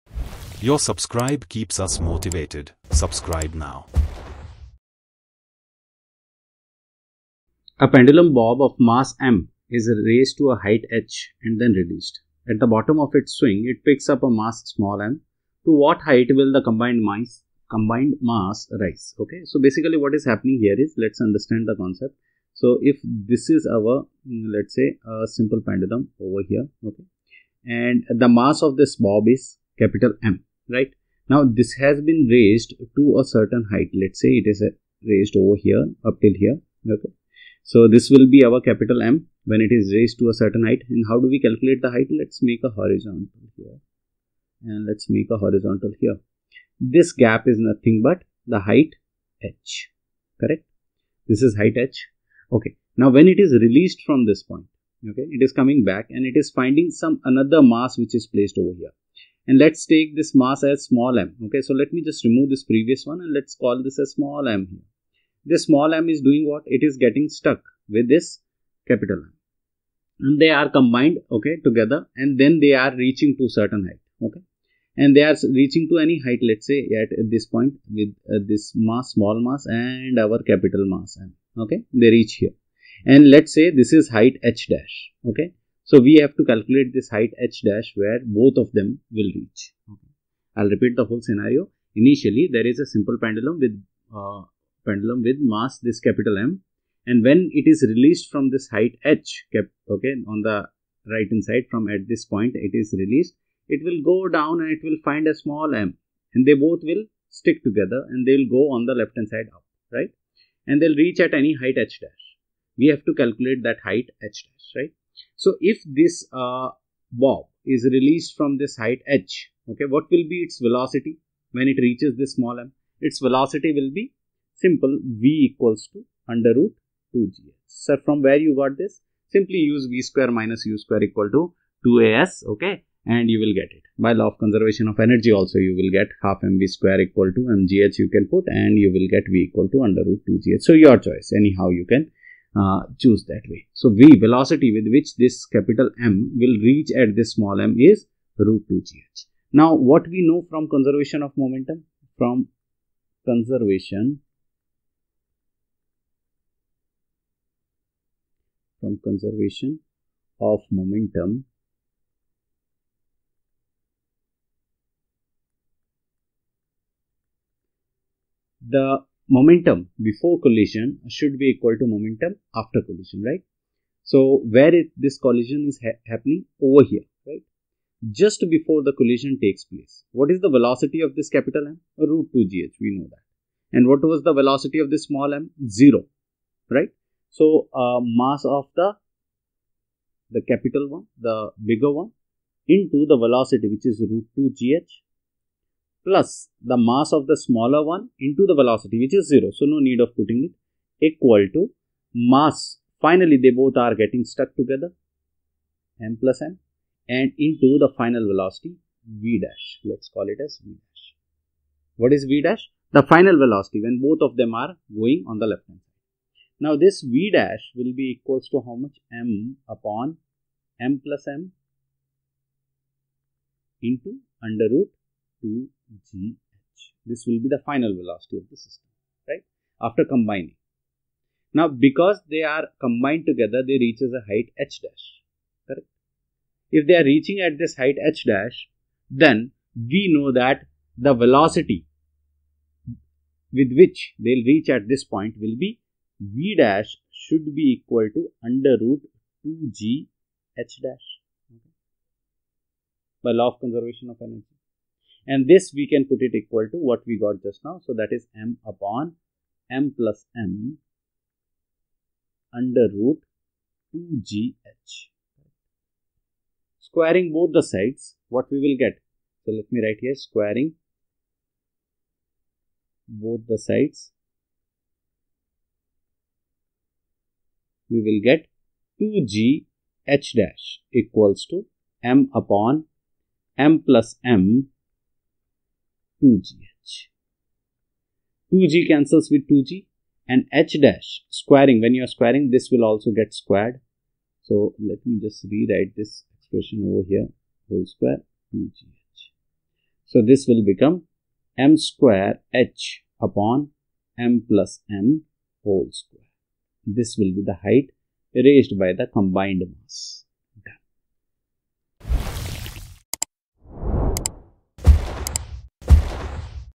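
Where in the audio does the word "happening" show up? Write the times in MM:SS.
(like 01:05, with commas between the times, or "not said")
00:20, 02:56.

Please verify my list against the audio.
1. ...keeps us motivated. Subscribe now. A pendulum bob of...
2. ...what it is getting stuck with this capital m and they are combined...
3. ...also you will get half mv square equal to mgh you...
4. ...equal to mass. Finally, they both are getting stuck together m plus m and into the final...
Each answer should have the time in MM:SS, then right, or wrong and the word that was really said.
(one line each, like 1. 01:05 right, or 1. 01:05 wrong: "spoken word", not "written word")
1. 00:01 right
2. 01:06 right
3. 02:15 right
4. 03:21 right.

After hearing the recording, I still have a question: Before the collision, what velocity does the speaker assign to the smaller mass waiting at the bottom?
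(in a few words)
0.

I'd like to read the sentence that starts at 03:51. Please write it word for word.
Now, because they are combined together, they reach as a height h dash, correct?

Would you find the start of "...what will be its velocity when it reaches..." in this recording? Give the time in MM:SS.
01:59.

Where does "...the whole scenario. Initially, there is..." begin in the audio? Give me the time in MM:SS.
01:30.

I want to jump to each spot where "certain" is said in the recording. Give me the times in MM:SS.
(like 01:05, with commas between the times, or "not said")
00:33, 00:40, 01:13.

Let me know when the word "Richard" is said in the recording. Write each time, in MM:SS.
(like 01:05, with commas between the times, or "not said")
not said.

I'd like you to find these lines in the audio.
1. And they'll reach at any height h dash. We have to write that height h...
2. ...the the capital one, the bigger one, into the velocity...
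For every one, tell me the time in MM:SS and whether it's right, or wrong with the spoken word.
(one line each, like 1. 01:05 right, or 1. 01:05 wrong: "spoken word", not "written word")
1. 01:50 wrong: "calculate", not "write"
2. 03:08 right.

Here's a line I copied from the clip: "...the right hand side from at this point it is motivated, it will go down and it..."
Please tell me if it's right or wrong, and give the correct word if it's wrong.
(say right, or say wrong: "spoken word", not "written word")
wrong: "released", not "motivated".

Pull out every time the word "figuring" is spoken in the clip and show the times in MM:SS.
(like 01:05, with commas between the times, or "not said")
not said.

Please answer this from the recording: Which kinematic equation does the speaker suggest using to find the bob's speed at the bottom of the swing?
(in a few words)
v² − u² = 2as.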